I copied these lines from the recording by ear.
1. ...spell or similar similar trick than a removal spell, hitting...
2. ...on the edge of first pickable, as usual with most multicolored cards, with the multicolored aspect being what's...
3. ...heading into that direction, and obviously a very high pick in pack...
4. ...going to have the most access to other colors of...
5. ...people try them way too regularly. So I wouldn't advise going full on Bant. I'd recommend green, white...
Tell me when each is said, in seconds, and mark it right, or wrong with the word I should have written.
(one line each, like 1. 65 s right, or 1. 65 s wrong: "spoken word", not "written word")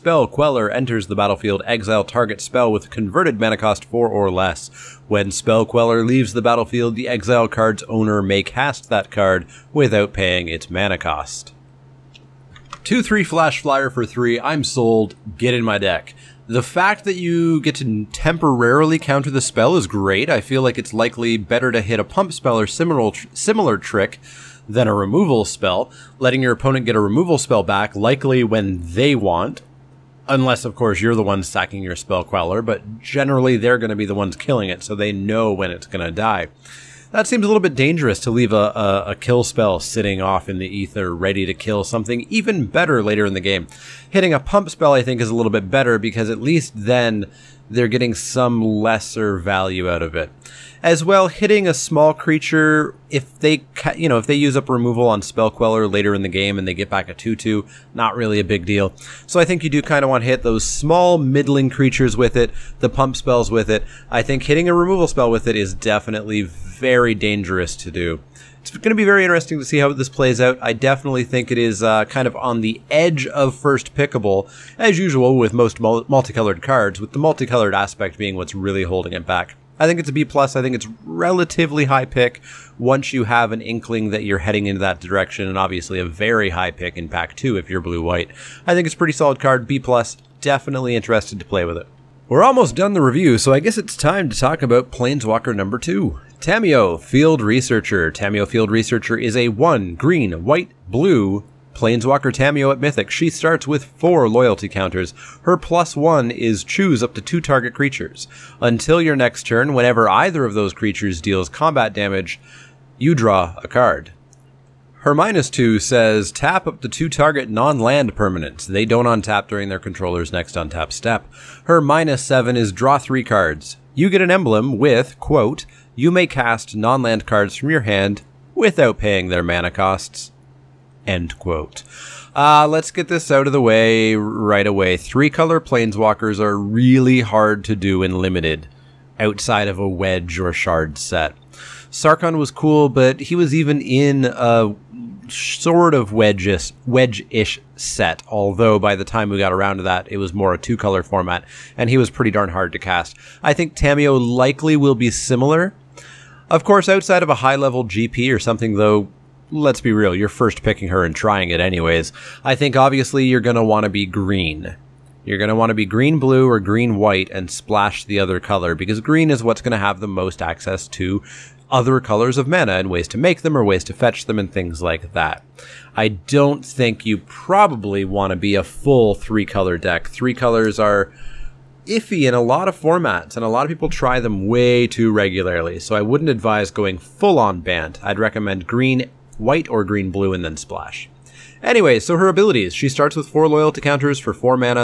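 1. 22 s wrong: "letting", not "hitting"
2. 72 s right
3. 84 s right
4. 169 s right
5. 183 s right.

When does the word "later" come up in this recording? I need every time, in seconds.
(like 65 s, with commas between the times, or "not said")
43 s, 55 s.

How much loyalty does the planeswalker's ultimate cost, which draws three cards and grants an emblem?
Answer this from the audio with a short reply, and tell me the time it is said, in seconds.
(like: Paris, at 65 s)
7, at 121 s.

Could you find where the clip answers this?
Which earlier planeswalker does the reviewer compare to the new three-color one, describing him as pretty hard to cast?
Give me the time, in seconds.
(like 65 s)
141 s.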